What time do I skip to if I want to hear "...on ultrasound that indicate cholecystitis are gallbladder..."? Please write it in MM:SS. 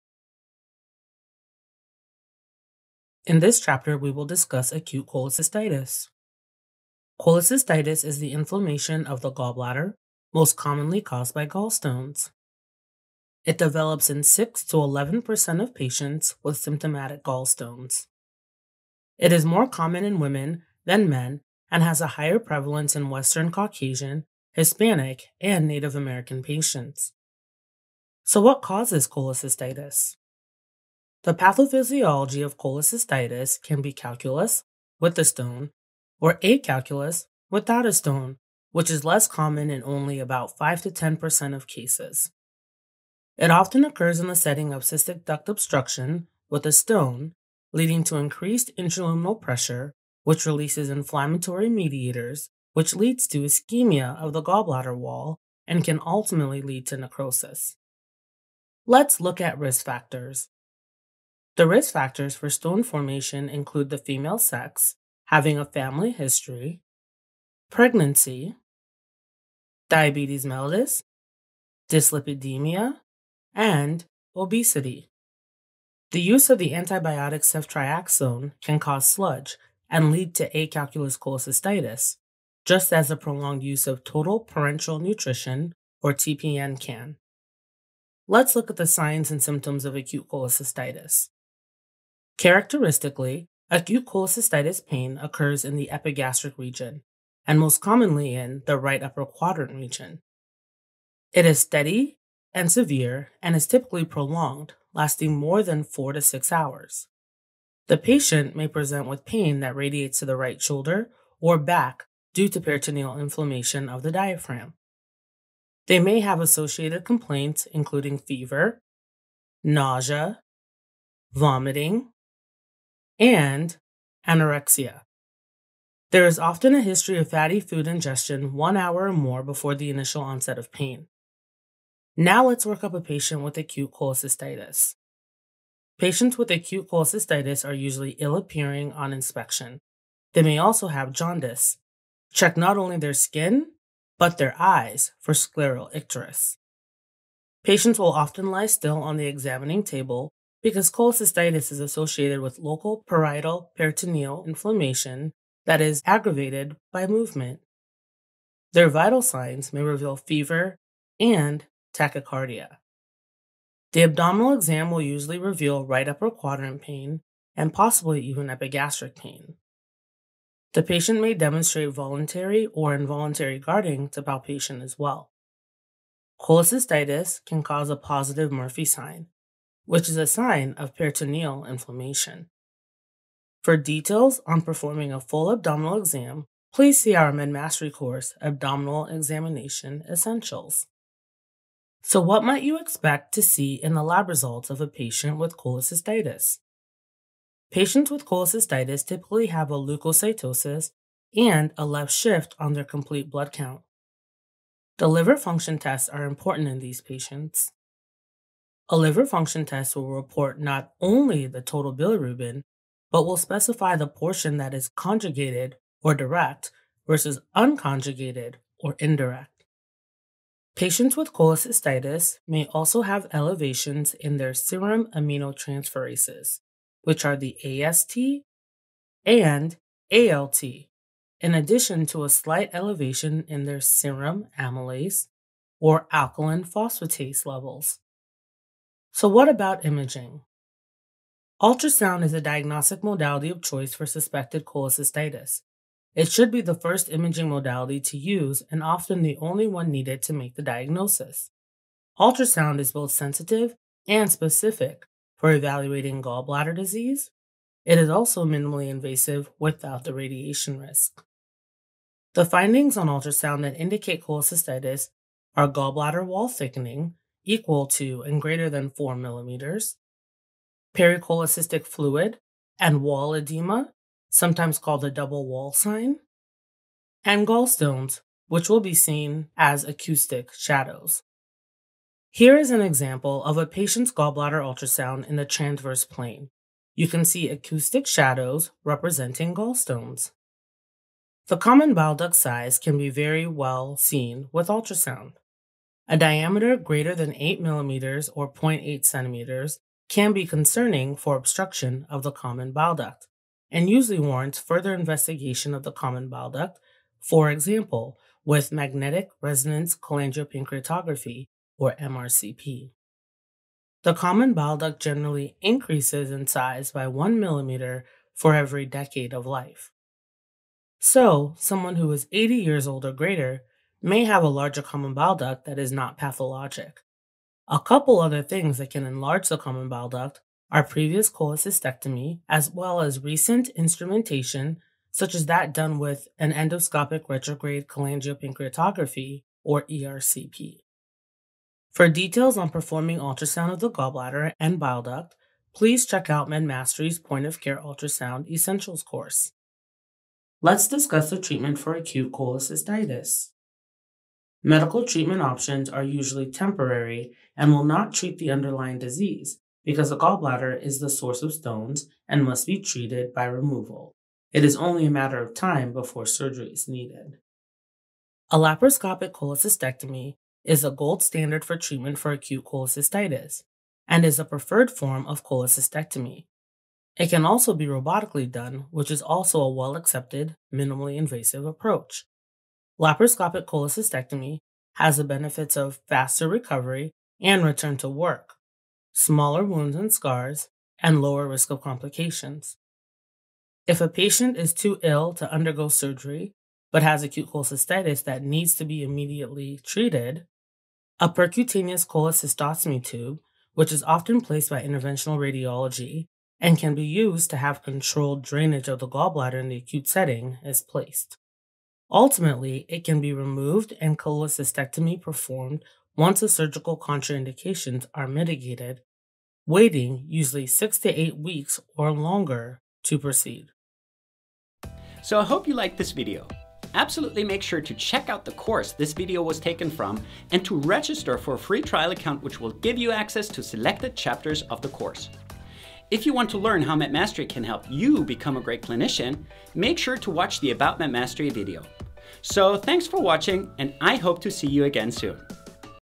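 04:22.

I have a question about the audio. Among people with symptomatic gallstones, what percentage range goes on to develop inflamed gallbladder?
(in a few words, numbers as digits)
6 to 11%.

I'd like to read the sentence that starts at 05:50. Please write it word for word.
Let's discuss the treatment for acute cholecystitis.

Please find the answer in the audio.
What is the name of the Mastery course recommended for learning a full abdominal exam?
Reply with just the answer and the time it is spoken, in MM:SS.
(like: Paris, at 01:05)
Abdominal Examination Essentials, at 03:08.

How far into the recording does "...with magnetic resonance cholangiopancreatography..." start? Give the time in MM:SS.
05:08.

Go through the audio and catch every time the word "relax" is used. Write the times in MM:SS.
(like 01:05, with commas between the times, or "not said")
not said.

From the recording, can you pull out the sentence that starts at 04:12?
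Ultrasound is both sensitive and specific for evaluating gallbladder disease.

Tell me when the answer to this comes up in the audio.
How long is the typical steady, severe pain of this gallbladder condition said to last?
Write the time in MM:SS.
01:45.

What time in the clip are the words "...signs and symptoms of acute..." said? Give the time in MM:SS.
01:28.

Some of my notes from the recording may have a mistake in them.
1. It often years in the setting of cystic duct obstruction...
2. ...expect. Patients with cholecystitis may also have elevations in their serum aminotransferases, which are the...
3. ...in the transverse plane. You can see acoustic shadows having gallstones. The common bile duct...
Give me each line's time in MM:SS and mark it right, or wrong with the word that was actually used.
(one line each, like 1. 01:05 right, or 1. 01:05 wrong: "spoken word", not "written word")
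1. 00:43 wrong: "occurs", not "years"
2. 03:38 wrong: "indirect", not "expect"
3. 04:45 wrong: "representing", not "having".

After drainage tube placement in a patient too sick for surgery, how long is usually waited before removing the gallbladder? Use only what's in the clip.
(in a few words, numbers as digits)
6 to 8 weeks.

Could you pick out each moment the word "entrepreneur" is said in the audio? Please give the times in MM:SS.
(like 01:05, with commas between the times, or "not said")
not said.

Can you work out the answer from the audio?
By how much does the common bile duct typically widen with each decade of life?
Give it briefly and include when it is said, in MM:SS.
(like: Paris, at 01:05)
1 millimeter, at 05:17.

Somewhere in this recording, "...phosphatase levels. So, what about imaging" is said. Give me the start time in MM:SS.
03:56.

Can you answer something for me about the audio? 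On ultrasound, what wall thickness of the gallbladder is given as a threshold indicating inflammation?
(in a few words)
4 millimeters.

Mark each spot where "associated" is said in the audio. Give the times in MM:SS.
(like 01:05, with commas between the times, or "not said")
01:56, 02:31.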